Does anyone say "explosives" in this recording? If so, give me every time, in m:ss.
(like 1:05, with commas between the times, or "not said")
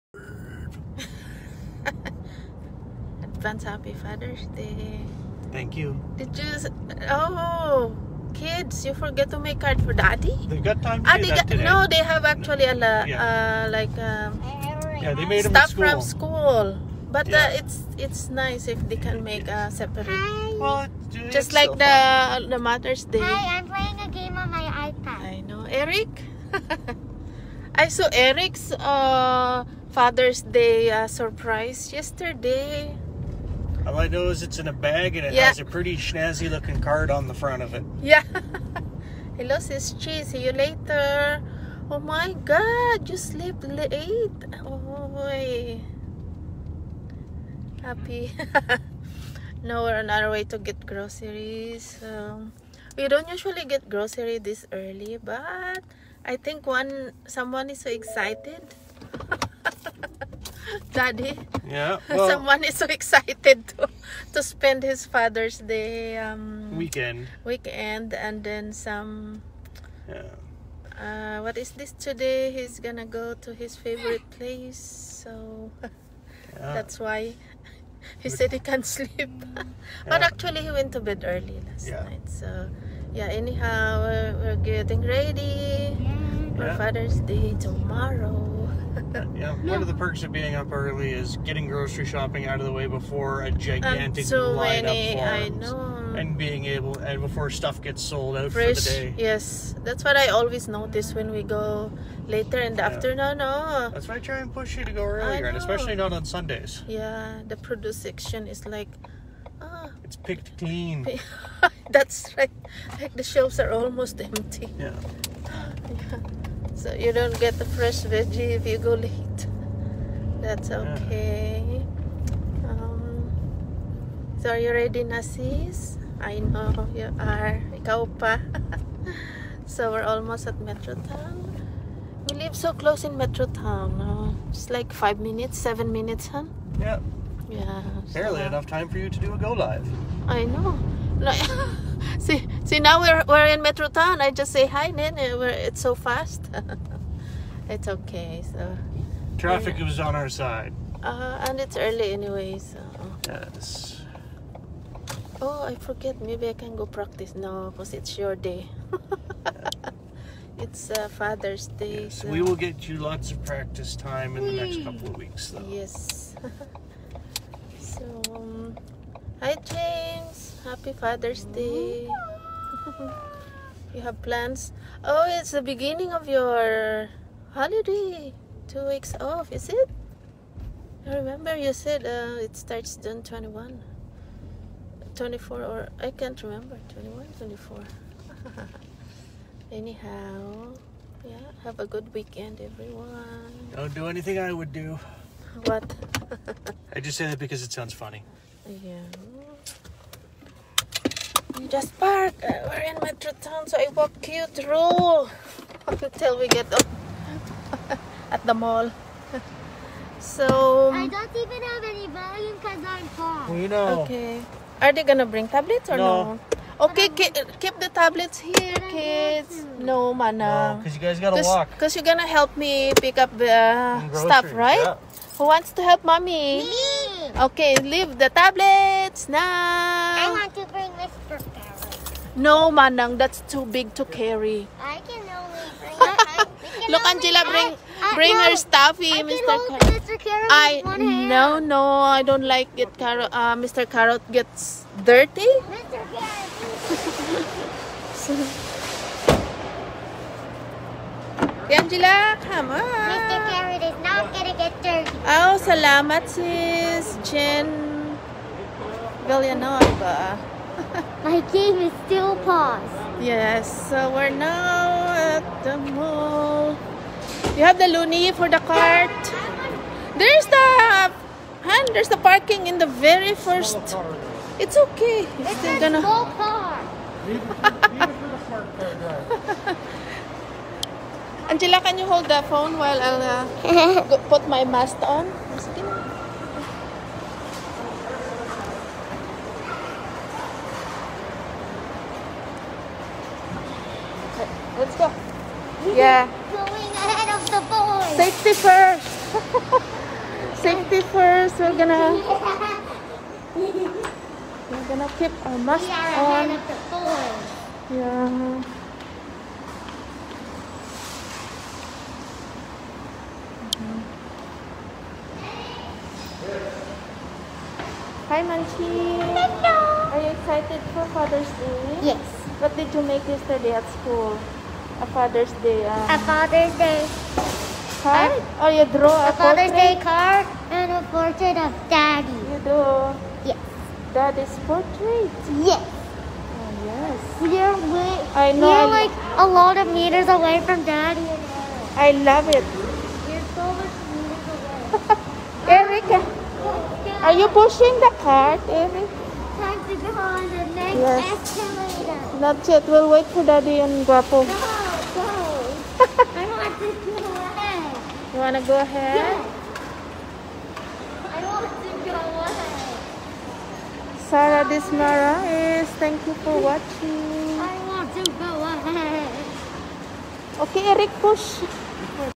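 not said.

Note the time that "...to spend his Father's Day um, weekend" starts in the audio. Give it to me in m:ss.
1:04.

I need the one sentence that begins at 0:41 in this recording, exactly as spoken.
Oh my god, you sleep late.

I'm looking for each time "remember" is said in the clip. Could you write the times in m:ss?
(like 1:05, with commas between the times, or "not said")
3:01, 3:06.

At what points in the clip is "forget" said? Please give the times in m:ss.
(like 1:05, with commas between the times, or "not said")
0:08, 2:35.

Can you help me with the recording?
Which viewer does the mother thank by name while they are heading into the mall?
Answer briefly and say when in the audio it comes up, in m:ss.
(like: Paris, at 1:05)
Jen Villanueva, at 4:17.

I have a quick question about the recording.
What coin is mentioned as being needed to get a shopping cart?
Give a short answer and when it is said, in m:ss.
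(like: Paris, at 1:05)
loonie, at 4:27.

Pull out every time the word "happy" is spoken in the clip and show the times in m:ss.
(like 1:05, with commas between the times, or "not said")
0:03, 0:47, 2:50.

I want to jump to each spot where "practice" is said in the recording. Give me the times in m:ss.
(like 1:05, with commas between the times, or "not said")
2:36, 2:43.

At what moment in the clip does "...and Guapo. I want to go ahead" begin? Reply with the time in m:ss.
5:53.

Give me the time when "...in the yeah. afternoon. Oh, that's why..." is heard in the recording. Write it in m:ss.
1:42.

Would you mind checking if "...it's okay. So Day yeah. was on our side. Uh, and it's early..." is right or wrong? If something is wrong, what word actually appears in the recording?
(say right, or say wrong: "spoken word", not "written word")
wrong: "Traffic", not "Day".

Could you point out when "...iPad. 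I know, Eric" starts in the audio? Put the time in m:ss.
0:24.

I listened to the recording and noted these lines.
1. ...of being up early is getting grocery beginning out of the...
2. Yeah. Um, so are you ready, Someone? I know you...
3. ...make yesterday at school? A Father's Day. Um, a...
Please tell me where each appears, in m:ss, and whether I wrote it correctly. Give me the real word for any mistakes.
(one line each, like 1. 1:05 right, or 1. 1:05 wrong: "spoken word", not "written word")
1. 1:30 wrong: "shopping", not "beginning"
2. 2:01 wrong: "Nasis", not "Someone"
3. 5:23 right.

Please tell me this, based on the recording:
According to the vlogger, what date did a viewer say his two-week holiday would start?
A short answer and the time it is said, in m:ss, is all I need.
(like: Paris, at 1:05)
June 21, at 3:02.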